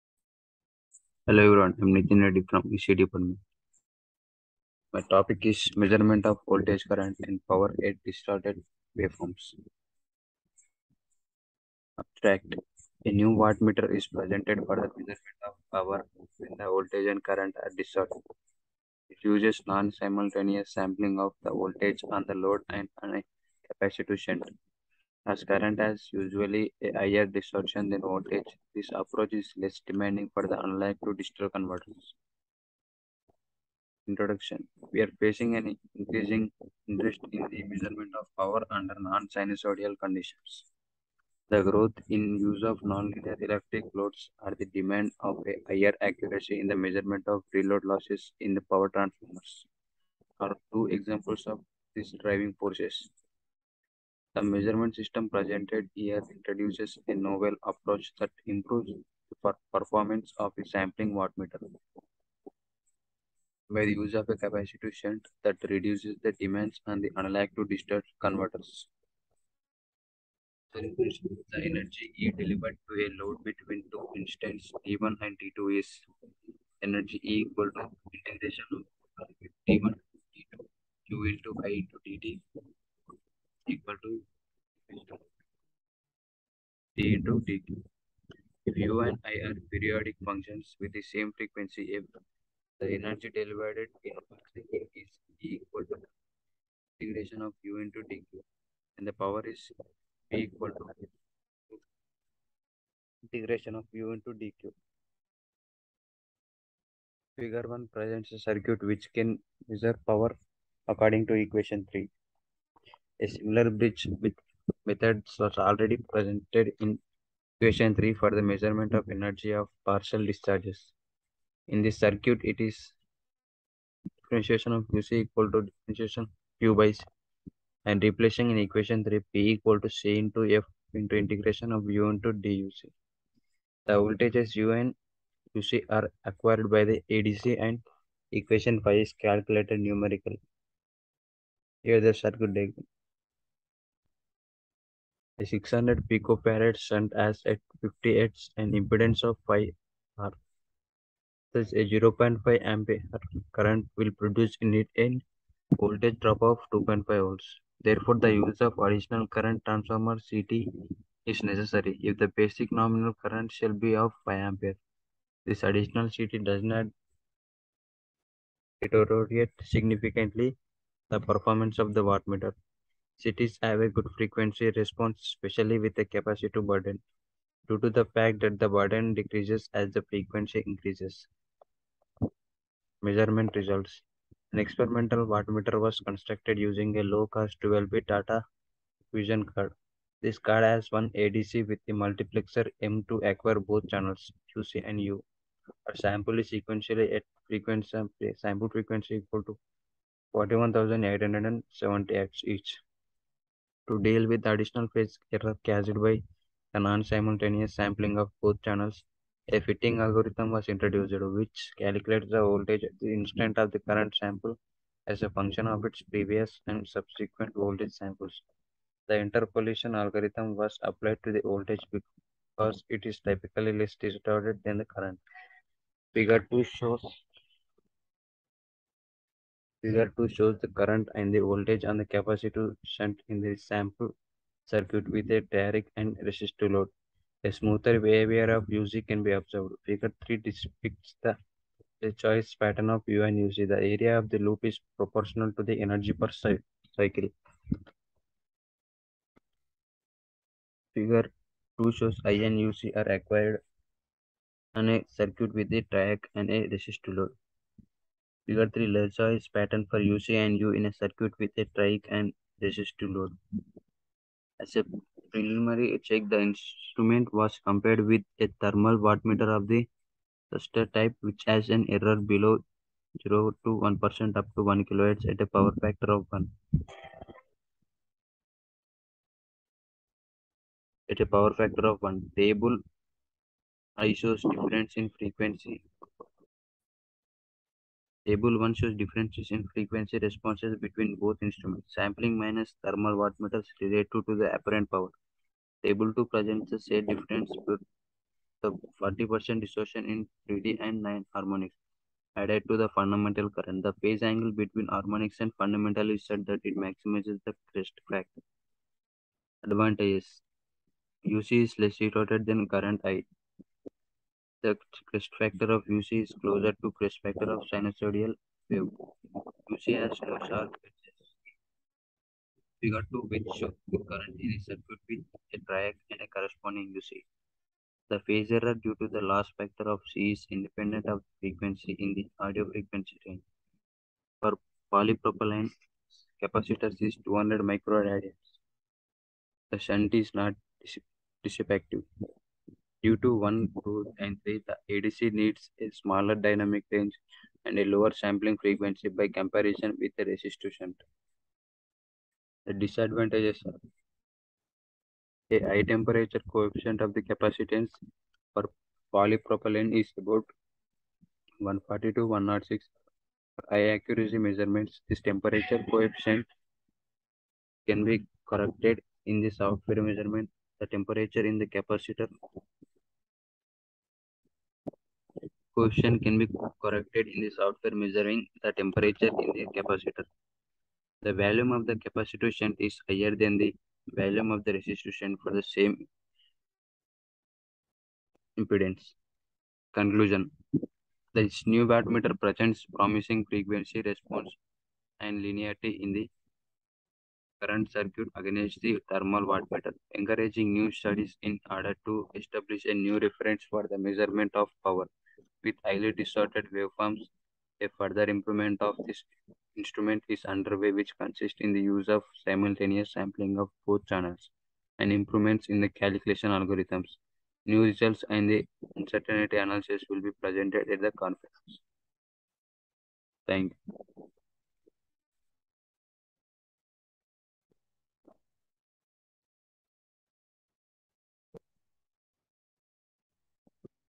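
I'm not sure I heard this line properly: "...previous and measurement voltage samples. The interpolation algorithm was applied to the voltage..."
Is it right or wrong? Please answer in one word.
wrong.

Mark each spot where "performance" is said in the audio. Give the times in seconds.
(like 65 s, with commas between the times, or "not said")
59 s, 171 s.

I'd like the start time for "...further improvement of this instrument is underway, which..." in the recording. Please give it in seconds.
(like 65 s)
407 s.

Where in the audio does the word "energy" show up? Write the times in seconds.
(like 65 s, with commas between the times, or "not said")
71 s, 76 s, 92 s, 119 s, 245 s.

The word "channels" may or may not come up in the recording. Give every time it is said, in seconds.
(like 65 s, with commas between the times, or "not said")
193 s, 208 s, 414 s.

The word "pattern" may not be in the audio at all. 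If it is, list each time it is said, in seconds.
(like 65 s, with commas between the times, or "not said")
242 s, 259 s.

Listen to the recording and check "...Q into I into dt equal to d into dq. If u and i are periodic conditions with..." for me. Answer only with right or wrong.
wrong.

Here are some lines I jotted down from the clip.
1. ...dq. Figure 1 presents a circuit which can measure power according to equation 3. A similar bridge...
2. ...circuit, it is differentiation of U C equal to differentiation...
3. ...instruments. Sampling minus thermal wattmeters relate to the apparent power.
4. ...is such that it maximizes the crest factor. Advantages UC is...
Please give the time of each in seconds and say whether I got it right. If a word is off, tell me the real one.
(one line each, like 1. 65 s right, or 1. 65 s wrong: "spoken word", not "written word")
1. 104 s right
2. 121 s right
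3. 291 s right
4. 306 s right.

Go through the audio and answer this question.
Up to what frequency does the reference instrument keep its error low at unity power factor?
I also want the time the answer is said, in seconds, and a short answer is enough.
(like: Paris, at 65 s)
1 kilohertz, at 274 s.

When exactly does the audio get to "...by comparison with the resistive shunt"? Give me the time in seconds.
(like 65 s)
349 s.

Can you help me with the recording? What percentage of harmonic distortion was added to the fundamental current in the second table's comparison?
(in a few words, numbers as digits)
40%.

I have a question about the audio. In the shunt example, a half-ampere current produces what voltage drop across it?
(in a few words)
2.5 volts.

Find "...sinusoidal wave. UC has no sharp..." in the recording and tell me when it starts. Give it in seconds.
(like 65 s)
317 s.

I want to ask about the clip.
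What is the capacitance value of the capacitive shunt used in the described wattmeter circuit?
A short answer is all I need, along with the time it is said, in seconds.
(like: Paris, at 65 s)
600 picofarad, at 145 s.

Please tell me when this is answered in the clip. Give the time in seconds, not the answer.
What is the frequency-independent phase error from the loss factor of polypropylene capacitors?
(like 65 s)
337 s.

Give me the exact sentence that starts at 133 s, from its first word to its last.
The voltages U and Uc are acquired by the ADC and equation 5 is calculated numerically.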